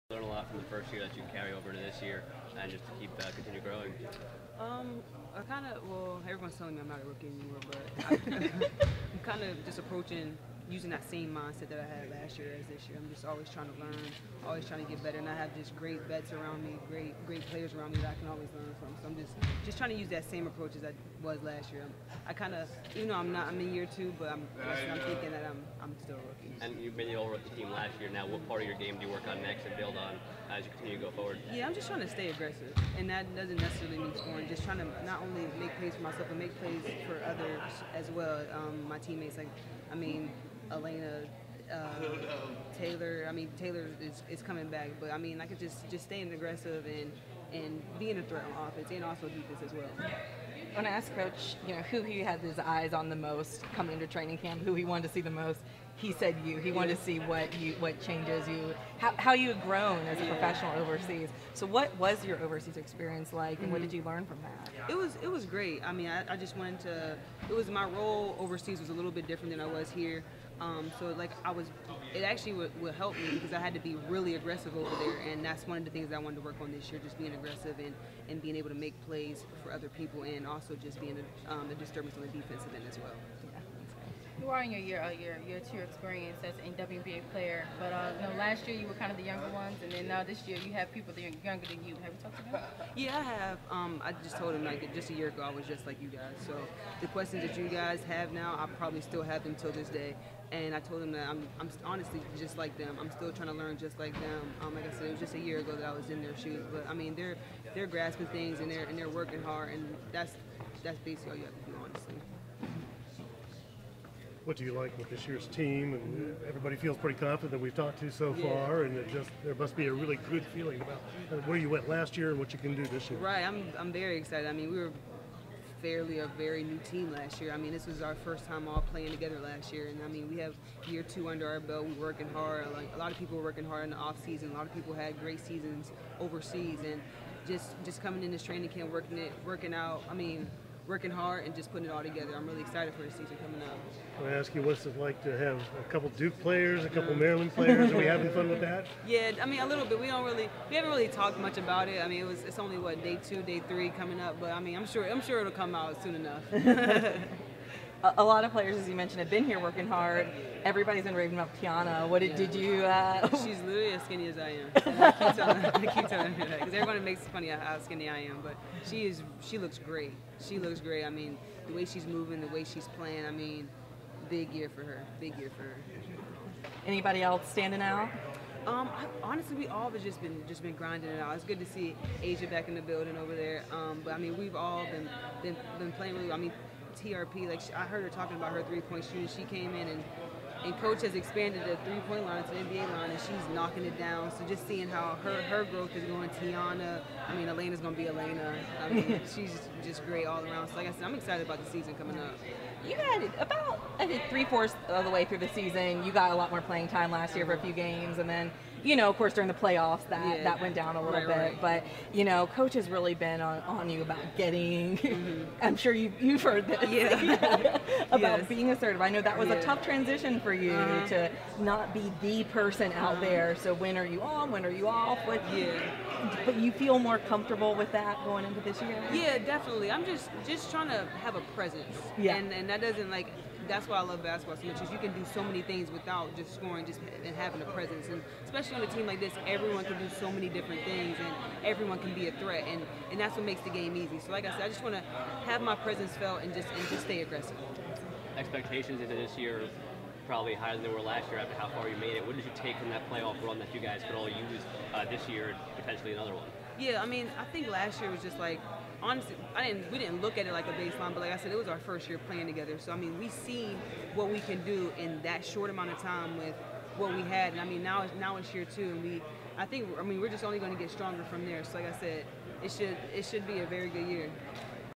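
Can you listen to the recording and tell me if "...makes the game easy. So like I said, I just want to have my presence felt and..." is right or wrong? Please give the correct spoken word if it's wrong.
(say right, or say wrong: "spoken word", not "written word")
right.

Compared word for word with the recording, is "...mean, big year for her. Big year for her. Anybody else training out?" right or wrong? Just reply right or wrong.
wrong.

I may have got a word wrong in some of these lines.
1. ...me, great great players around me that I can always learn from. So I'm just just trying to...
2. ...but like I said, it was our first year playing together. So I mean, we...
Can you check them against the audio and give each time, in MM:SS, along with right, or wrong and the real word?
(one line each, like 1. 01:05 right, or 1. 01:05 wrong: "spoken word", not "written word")
1. 00:16 right
2. 04:21 right.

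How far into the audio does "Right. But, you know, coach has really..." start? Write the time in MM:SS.
03:31.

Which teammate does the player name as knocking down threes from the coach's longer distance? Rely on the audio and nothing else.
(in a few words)
TRP.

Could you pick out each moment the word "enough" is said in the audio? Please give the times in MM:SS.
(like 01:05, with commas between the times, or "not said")
02:36.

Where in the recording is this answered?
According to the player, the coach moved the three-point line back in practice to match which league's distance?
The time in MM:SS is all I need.
03:12.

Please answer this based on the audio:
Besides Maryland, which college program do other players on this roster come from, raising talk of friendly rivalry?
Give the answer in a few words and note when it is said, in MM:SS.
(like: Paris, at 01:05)
Duke, at 02:26.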